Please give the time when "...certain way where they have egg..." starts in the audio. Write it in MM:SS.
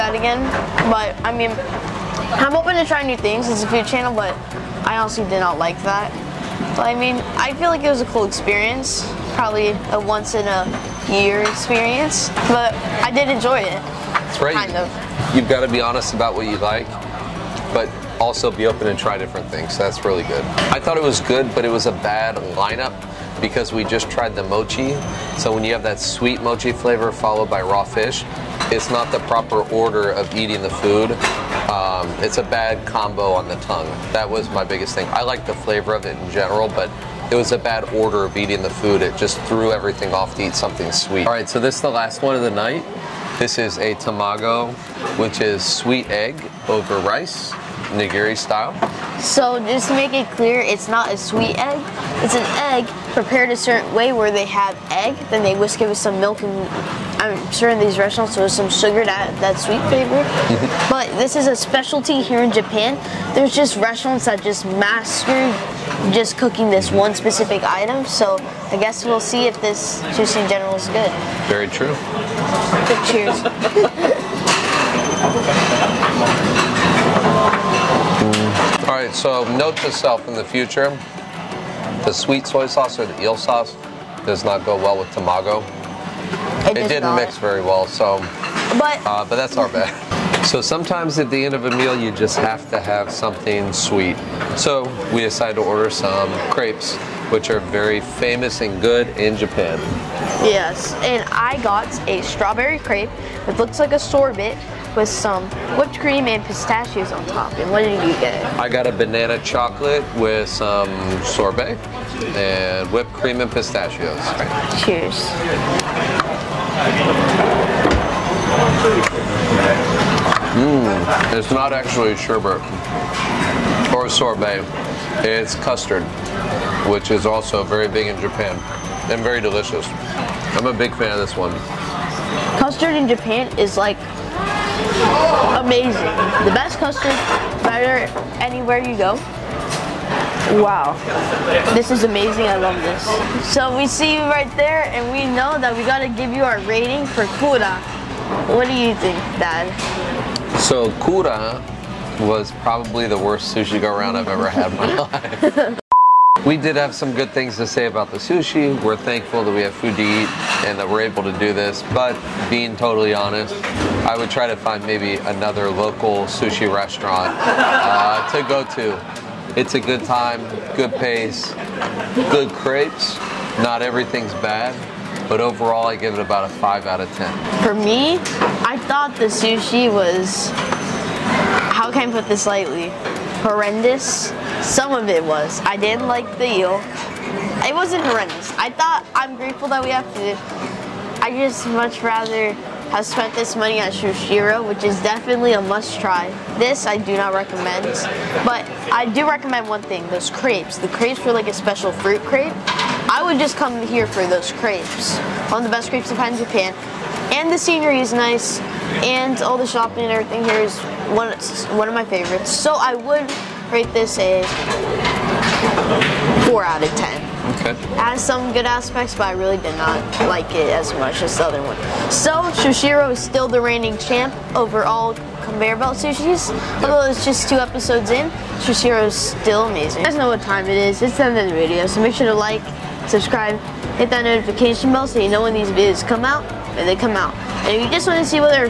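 00:53.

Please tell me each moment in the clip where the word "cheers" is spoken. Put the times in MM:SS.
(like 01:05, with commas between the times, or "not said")
01:13, 01:54.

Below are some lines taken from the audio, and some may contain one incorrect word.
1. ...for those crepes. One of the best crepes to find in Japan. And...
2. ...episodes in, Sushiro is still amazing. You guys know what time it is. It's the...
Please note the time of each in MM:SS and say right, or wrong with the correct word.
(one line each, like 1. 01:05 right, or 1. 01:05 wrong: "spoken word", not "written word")
1. 03:24 right
2. 03:47 right.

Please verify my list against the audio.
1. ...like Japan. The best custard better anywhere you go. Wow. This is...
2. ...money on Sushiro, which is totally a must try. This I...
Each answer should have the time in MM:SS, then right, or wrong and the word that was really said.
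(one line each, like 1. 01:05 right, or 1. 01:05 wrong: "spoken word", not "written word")
1. 02:13 wrong: "Amazing", not "Japan"
2. 03:13 wrong: "definitely", not "totally".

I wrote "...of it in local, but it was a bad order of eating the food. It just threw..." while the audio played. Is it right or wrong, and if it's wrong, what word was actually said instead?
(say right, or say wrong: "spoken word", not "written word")
wrong: "general", not "local".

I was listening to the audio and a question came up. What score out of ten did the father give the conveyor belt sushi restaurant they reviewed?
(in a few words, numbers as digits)
5.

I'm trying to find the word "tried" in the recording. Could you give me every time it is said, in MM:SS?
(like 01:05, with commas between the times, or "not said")
00:24.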